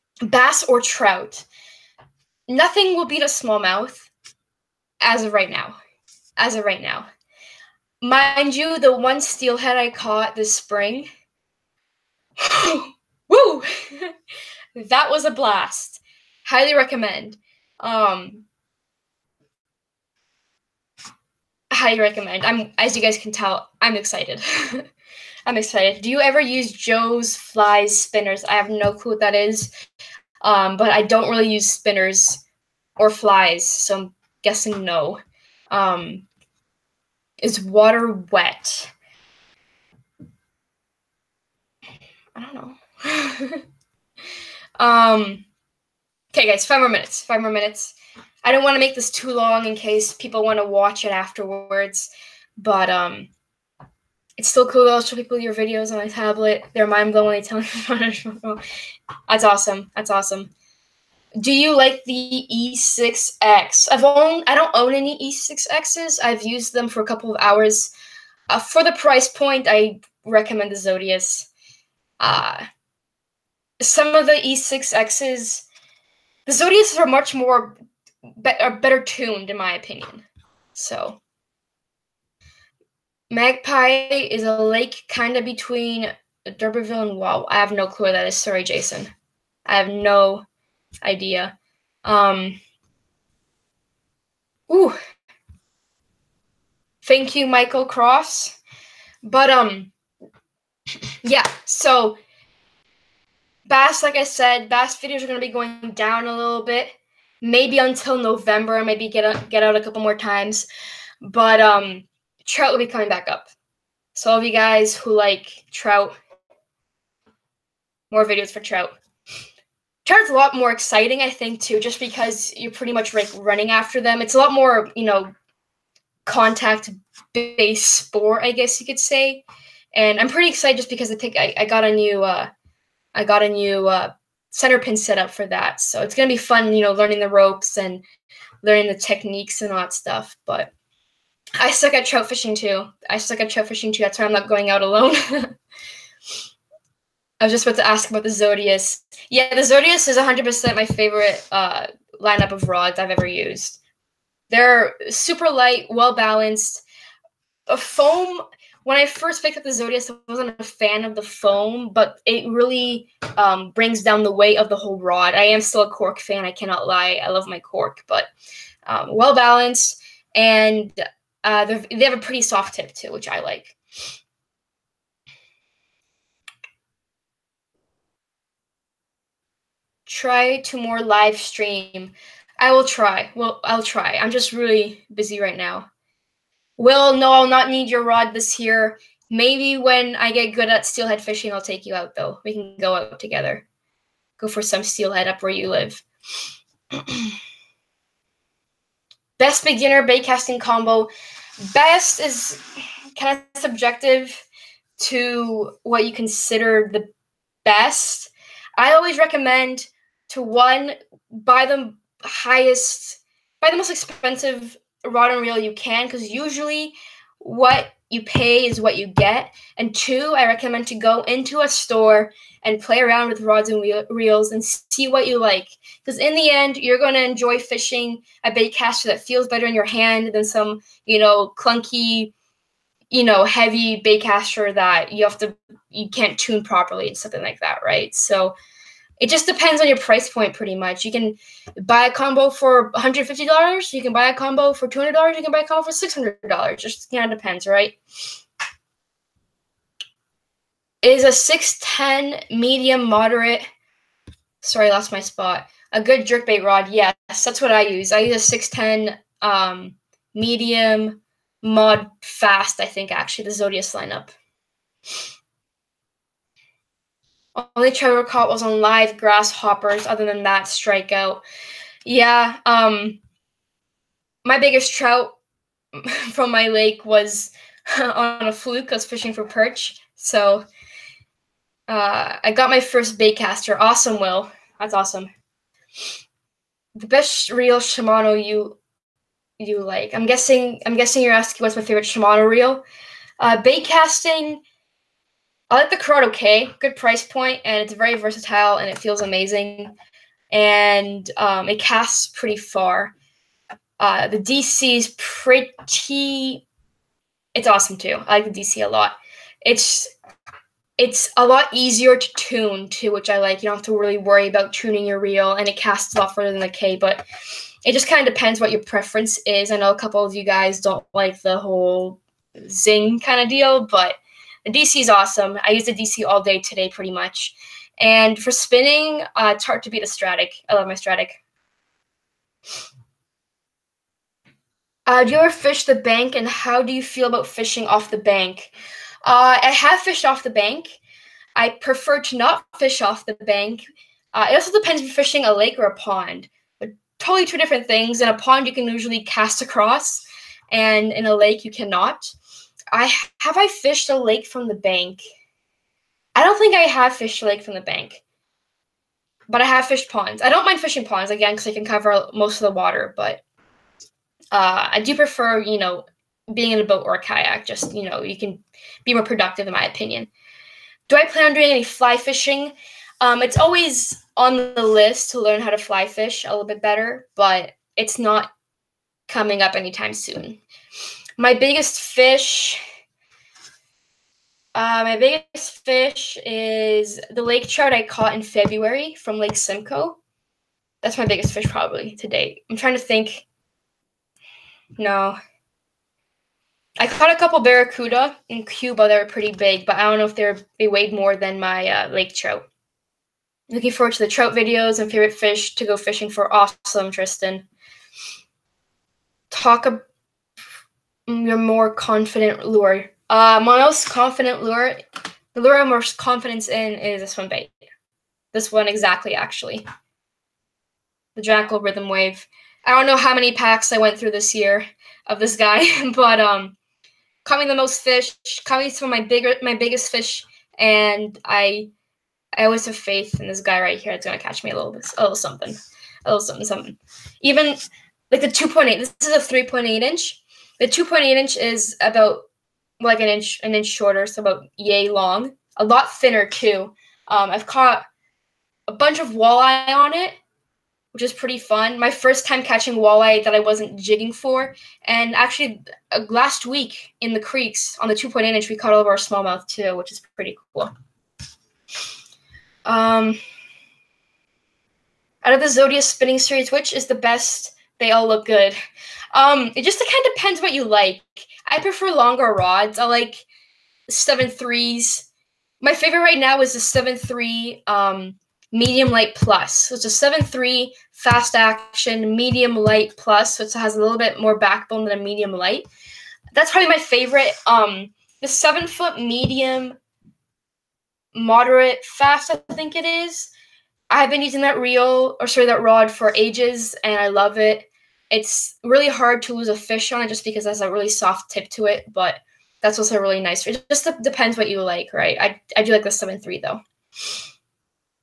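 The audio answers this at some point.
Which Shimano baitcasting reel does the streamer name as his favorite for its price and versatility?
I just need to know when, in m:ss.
4:55.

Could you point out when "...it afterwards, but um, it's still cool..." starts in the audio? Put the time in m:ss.
0:51.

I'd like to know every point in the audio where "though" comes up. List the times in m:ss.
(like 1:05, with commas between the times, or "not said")
0:54, 3:12, 8:26.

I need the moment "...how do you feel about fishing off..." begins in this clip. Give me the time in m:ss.
5:36.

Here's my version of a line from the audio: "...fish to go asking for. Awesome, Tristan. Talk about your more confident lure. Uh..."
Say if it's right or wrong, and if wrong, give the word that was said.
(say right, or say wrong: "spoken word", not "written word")
wrong: "fishing", not "asking".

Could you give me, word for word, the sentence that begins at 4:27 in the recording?
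Only Trevor caught was on live grasshoppers.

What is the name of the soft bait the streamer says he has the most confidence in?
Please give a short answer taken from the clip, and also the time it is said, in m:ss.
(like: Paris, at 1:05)
Jackall Rhythm Wave, at 7:01.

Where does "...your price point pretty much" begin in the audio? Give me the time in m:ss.
3:59.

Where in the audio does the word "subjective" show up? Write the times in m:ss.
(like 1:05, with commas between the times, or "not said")
3:23.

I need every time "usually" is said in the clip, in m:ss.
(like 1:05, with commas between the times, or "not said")
3:36, 5:48.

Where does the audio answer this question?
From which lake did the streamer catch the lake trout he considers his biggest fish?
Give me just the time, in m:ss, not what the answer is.
6:29.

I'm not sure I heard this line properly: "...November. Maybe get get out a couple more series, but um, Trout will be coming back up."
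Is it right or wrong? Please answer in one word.
wrong.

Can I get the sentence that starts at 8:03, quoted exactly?
So it has a little bit more backbone than a medium light.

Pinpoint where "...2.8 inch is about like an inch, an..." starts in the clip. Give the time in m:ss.
7:20.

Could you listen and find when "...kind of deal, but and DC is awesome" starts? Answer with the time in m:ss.
5:23.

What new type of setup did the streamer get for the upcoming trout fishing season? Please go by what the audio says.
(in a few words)
center pin.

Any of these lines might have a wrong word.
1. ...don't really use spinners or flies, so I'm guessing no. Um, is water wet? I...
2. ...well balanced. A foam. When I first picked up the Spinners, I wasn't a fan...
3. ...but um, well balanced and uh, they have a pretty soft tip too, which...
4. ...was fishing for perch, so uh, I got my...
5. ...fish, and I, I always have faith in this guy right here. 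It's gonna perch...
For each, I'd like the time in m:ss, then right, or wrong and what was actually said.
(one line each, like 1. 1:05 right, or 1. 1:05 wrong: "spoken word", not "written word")
1. 0:31 right
2. 2:35 wrong: "Zodias", not "Spinners"
3. 2:48 right
4. 4:38 right
5. 7:10 wrong: "catch", not "perch".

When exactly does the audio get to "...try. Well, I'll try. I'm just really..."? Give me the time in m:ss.
3:02.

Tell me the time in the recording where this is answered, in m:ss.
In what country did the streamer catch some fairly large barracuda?
6:38.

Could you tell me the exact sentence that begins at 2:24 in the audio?
That's why I'm not going out alone.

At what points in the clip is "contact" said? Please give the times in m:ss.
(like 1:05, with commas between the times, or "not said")
2:06.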